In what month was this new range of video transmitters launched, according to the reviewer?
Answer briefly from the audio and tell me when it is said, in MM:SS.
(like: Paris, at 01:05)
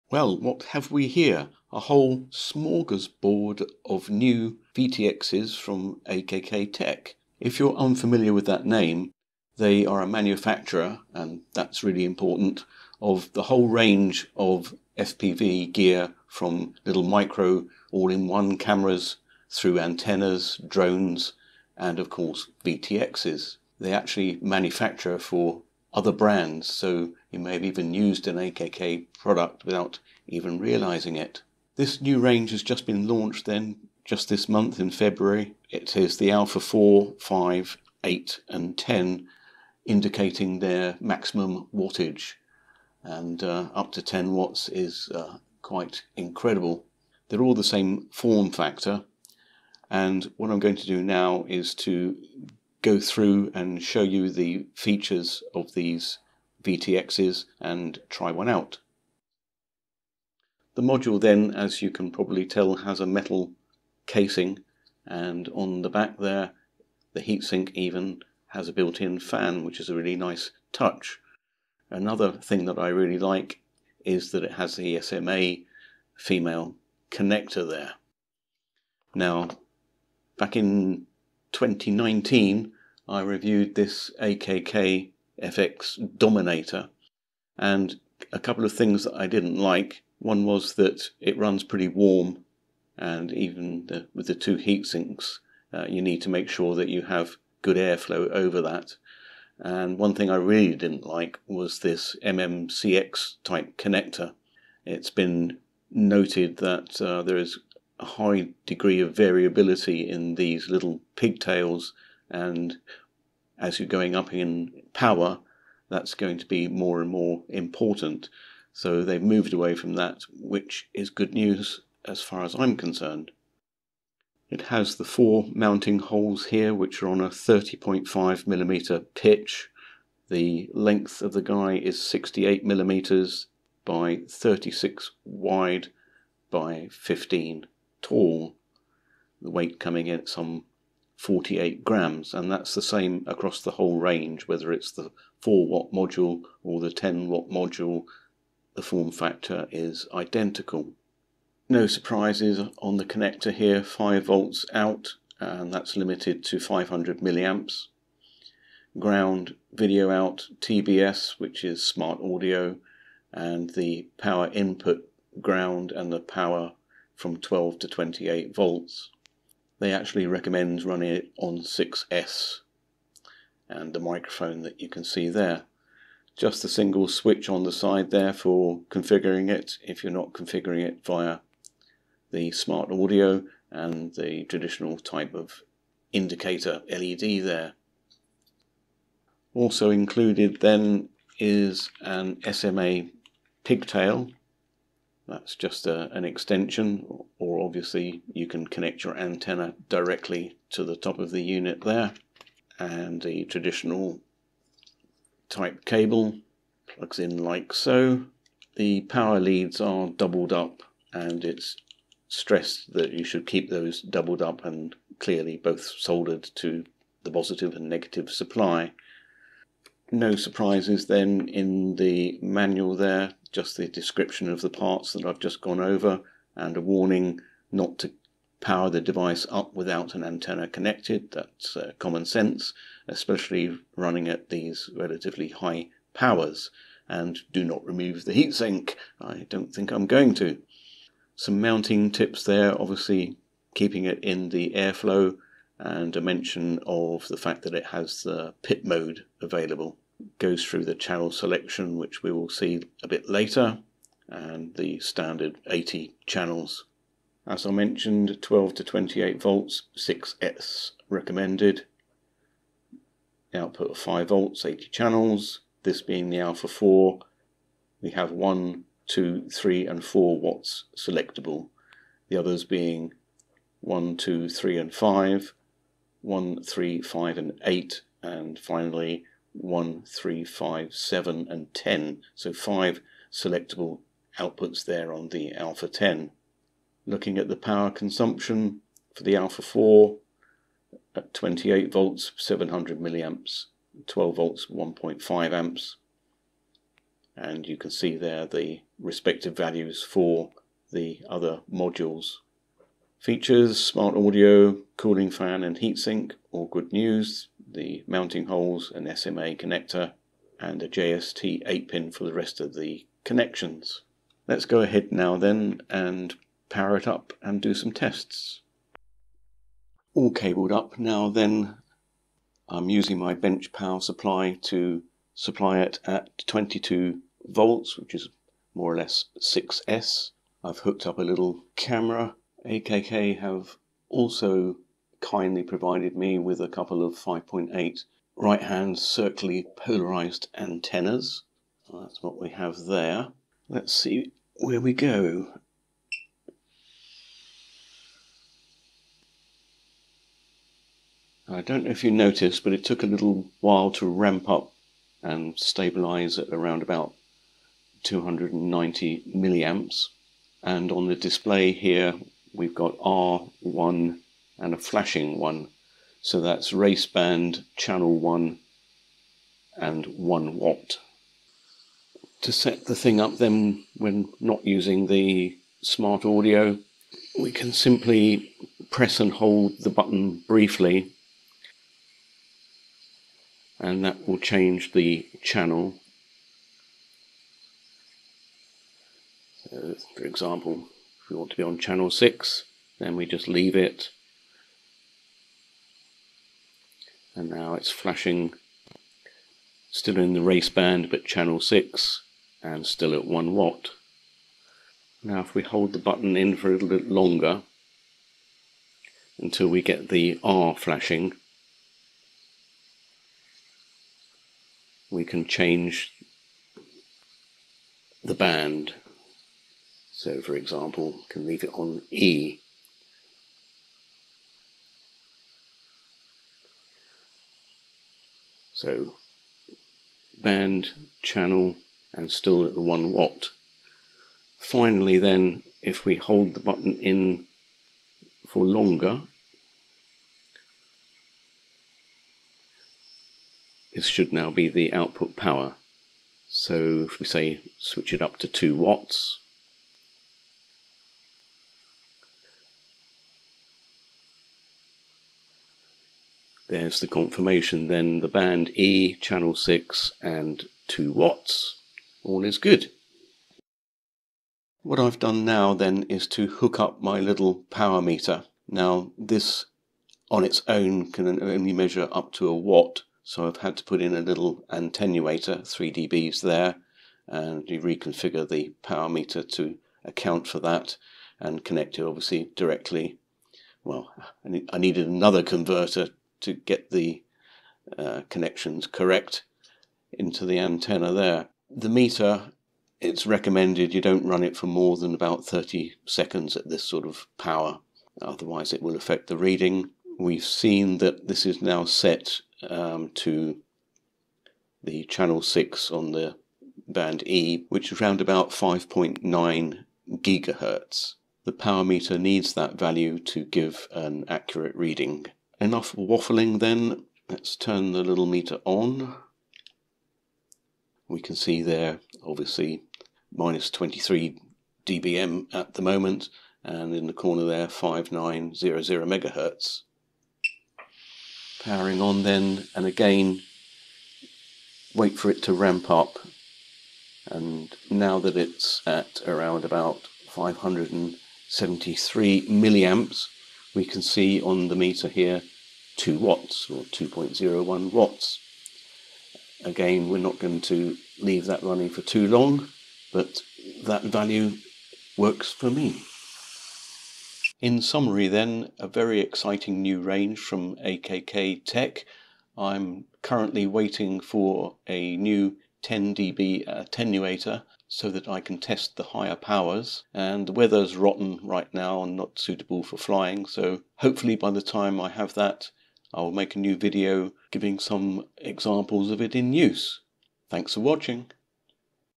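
February, at 00:34.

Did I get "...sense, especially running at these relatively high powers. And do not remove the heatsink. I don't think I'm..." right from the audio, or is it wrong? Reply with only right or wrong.
right.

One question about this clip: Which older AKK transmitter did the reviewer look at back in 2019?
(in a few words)
FX Dominator.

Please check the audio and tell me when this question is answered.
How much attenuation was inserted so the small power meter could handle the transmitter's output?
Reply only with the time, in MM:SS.
07:55.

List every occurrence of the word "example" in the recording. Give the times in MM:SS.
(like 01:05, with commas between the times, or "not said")
06:30, 07:00, 09:38.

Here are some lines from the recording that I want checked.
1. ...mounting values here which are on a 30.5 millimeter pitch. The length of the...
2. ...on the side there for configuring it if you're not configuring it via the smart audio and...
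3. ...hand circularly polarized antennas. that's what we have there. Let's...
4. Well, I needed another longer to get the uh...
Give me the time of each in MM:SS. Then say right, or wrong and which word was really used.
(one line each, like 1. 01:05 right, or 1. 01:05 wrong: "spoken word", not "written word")
1. 02:05 wrong: "holes", not "values"
2. 02:57 right
3. 05:38 right
4. 08:03 wrong: "converter", not "longer".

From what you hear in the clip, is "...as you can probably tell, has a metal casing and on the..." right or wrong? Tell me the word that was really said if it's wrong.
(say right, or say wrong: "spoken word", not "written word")
right.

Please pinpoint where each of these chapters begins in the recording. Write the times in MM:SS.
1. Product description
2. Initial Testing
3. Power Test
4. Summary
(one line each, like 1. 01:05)
1. 00:59
2. 05:18
3. 07:43
4. 09:17.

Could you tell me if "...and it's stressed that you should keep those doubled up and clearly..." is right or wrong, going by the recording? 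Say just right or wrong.
right.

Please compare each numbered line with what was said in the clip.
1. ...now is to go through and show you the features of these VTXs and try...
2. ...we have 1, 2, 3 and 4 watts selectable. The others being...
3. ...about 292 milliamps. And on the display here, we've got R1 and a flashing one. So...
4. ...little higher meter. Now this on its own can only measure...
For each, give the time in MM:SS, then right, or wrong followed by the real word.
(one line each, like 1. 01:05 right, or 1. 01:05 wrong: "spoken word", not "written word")
1. 00:51 right
2. 04:28 right
3. 05:56 wrong: "290", not "292"
4. 07:47 wrong: "power", not "higher".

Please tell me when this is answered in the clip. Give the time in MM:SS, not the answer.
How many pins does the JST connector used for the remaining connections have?
05:11.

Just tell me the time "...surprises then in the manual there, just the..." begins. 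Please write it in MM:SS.
03:40.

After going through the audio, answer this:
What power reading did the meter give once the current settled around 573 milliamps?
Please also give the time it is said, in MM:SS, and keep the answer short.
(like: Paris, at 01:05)
2.01 watts, at 09:06.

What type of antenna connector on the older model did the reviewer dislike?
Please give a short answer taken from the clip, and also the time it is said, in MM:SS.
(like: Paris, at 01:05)
MMCX, at 01:42.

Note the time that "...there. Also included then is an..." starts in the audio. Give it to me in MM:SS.
03:07.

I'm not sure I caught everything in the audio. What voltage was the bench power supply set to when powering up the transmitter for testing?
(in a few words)
22 volts.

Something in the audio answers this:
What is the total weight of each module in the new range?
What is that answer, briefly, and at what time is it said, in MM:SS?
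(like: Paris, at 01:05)
48 grams, at 02:21.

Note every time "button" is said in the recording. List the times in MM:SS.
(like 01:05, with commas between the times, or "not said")
06:19, 06:45, 07:16.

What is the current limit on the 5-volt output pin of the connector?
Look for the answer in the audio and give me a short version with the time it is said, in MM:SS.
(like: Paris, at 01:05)
500 milliamps, at 02:36.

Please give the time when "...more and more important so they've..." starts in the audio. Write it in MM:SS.
01:56.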